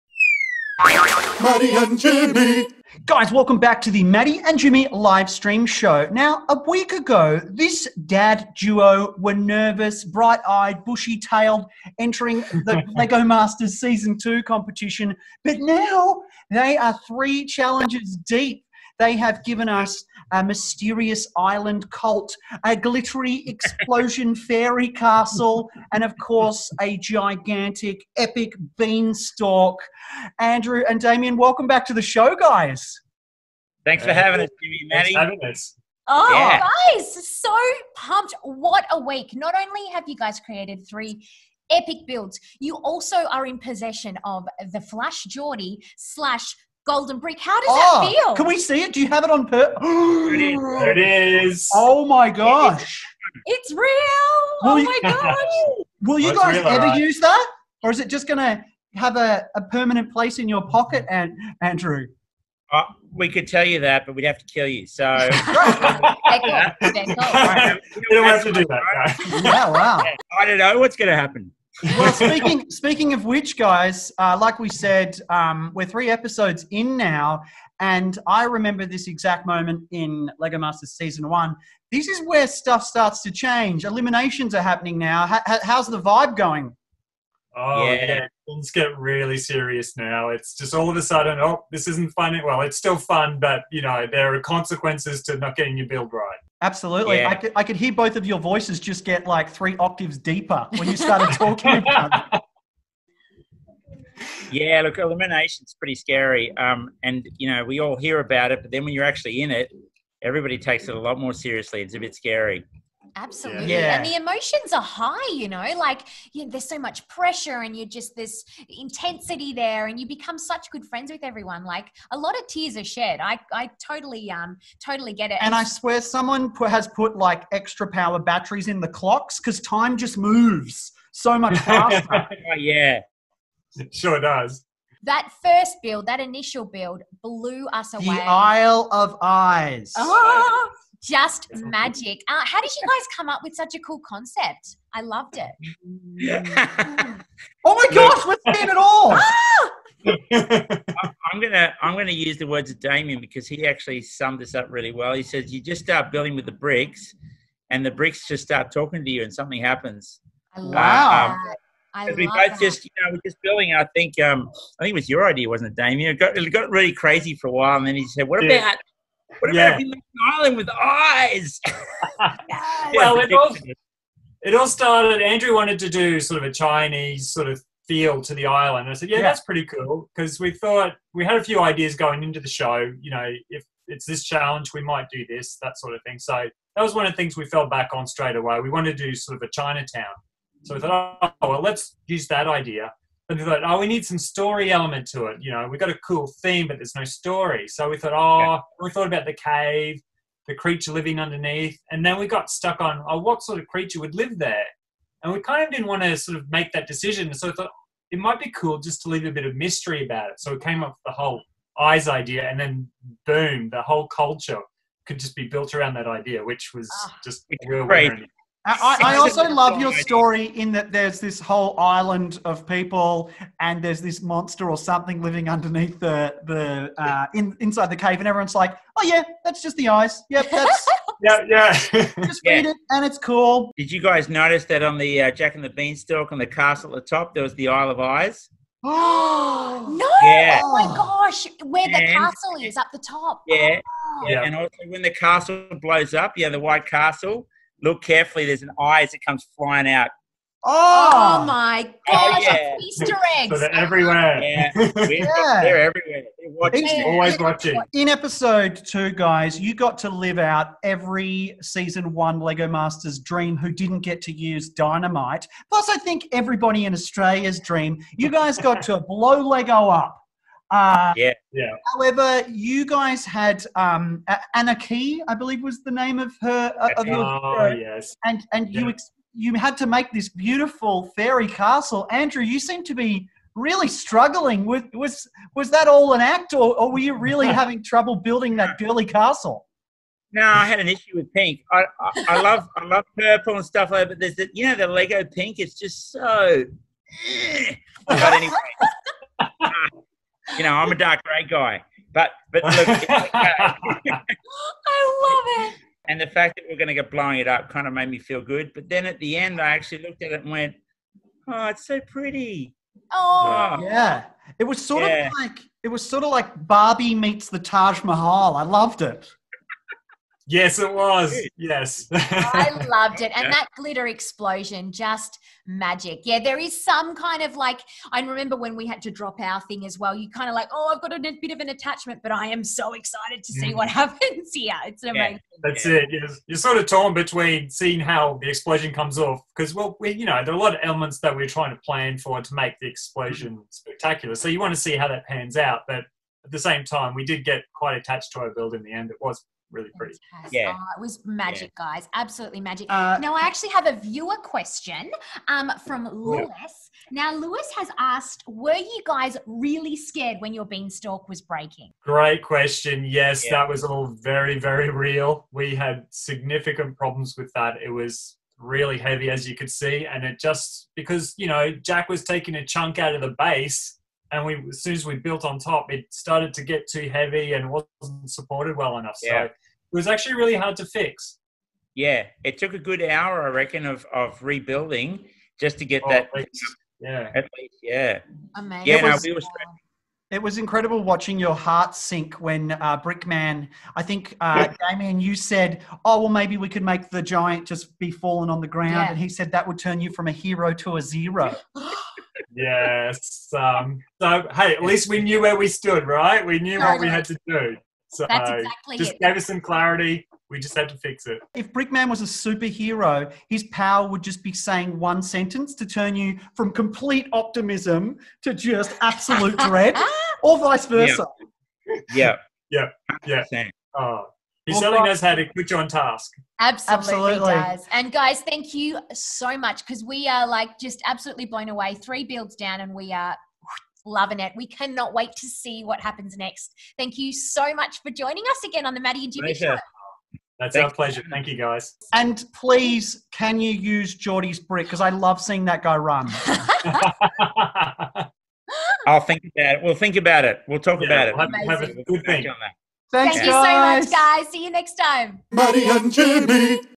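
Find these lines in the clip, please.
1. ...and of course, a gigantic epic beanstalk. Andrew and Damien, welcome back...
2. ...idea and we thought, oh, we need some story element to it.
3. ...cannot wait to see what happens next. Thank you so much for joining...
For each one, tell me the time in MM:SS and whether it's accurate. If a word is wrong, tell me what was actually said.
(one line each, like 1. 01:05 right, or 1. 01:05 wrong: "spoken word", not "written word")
1. 00:25 right
2. 03:12 right
3. 07:14 right.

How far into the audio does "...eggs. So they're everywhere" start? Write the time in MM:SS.
04:13.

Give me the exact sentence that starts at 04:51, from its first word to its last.
I, I, I love I love purple and stuff like that, but there's the, you know the Lego pink.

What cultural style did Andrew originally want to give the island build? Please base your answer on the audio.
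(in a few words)
Chinese.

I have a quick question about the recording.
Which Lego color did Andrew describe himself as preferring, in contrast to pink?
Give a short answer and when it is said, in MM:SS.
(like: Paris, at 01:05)
Dark grey, at 05:00.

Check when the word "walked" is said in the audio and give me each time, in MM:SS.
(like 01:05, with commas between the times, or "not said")
not said.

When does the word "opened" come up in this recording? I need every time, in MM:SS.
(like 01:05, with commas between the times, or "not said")
not said.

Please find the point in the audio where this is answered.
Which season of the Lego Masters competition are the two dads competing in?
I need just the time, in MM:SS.
00:13.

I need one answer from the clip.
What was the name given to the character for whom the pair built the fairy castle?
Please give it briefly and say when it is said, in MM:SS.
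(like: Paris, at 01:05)
Anna Key, at 04:34.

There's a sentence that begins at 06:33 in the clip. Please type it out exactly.
I think uh, Damien, you said, "Oh well, maybe we could make the giant just be fallen on the ground," yeah.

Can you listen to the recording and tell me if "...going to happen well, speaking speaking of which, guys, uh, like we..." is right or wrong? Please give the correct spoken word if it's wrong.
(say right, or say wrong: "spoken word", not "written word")
right.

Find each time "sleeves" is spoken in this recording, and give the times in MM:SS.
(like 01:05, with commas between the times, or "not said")
not said.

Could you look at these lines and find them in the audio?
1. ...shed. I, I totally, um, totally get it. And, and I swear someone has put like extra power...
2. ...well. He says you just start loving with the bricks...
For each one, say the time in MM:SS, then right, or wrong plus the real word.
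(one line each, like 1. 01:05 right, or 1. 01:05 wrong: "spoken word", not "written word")
1. 02:02 right
2. 02:34 wrong: "building", not "loving".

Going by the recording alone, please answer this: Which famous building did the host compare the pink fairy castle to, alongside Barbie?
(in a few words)
Taj Mahal.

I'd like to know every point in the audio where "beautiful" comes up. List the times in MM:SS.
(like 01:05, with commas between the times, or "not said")
04:40.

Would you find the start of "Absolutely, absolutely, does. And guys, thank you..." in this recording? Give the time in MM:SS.
07:06.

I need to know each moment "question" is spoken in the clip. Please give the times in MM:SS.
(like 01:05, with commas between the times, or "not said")
05:54, 06:02.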